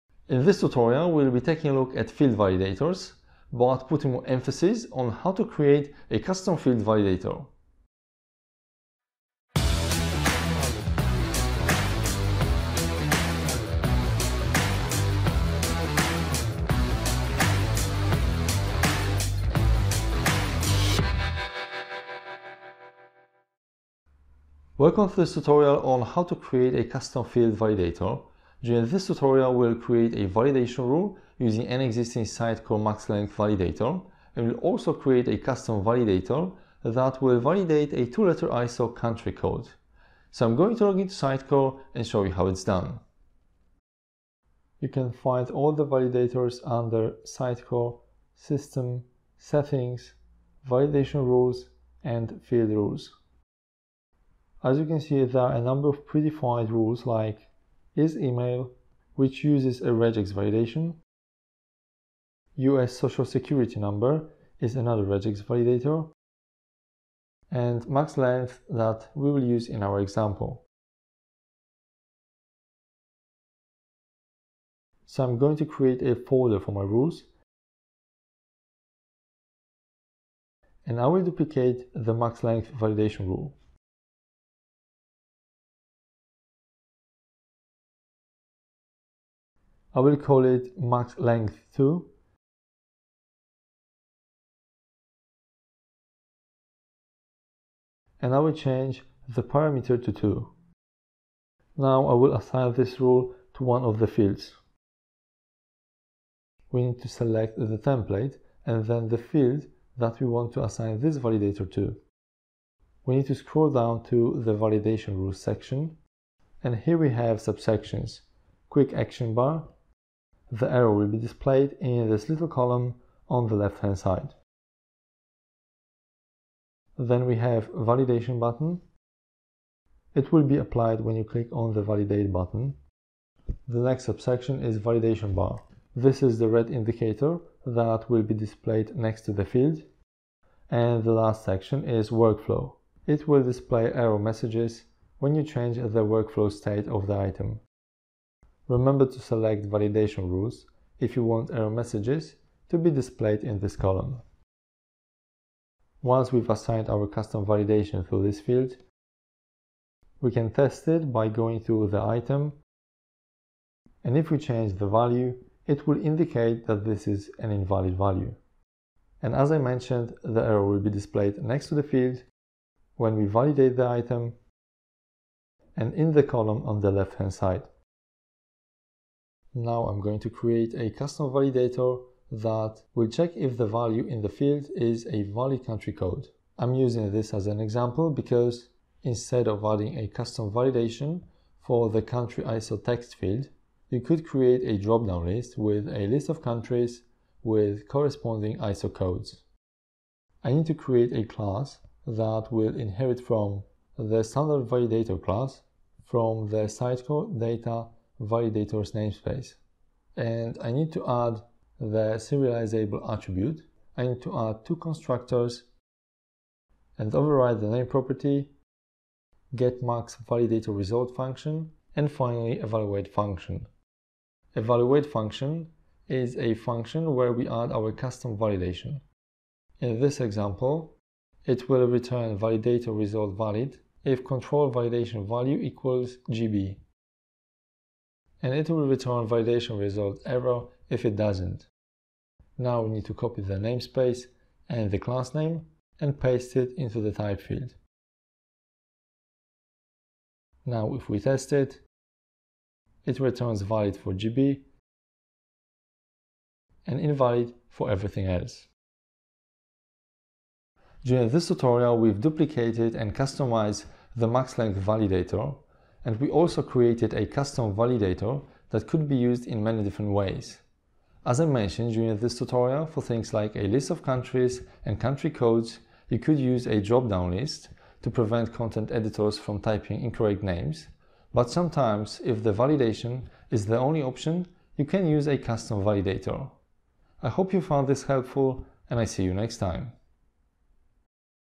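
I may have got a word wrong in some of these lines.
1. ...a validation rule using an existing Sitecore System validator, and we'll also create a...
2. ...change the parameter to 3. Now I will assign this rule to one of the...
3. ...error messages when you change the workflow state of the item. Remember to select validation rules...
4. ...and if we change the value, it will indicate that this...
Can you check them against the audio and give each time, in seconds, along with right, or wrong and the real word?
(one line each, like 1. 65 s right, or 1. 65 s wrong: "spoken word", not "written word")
1. 30 s wrong: "MaxLength", not "System"
2. 98 s wrong: "2", not "3"
3. 143 s right
4. 164 s right.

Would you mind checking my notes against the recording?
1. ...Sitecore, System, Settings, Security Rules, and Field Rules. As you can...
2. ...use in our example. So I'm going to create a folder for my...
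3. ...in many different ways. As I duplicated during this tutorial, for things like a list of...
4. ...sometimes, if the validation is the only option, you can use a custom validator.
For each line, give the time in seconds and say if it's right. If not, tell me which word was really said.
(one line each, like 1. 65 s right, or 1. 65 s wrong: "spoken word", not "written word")
1. 47 s wrong: "Validation", not "Security"
2. 69 s right
3. 269 s wrong: "mentioned", not "duplicated"
4. 281 s right.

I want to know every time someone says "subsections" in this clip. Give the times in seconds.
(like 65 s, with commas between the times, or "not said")
117 s, 134 s.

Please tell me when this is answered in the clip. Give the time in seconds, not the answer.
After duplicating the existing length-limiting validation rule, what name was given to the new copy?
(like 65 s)
90 s.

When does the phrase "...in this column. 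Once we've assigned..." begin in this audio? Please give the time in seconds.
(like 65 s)
153 s.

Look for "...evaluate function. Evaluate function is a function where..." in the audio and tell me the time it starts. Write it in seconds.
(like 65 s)
222 s.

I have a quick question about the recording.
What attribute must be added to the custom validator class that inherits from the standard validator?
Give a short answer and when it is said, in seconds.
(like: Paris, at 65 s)
serializable, at 212 s.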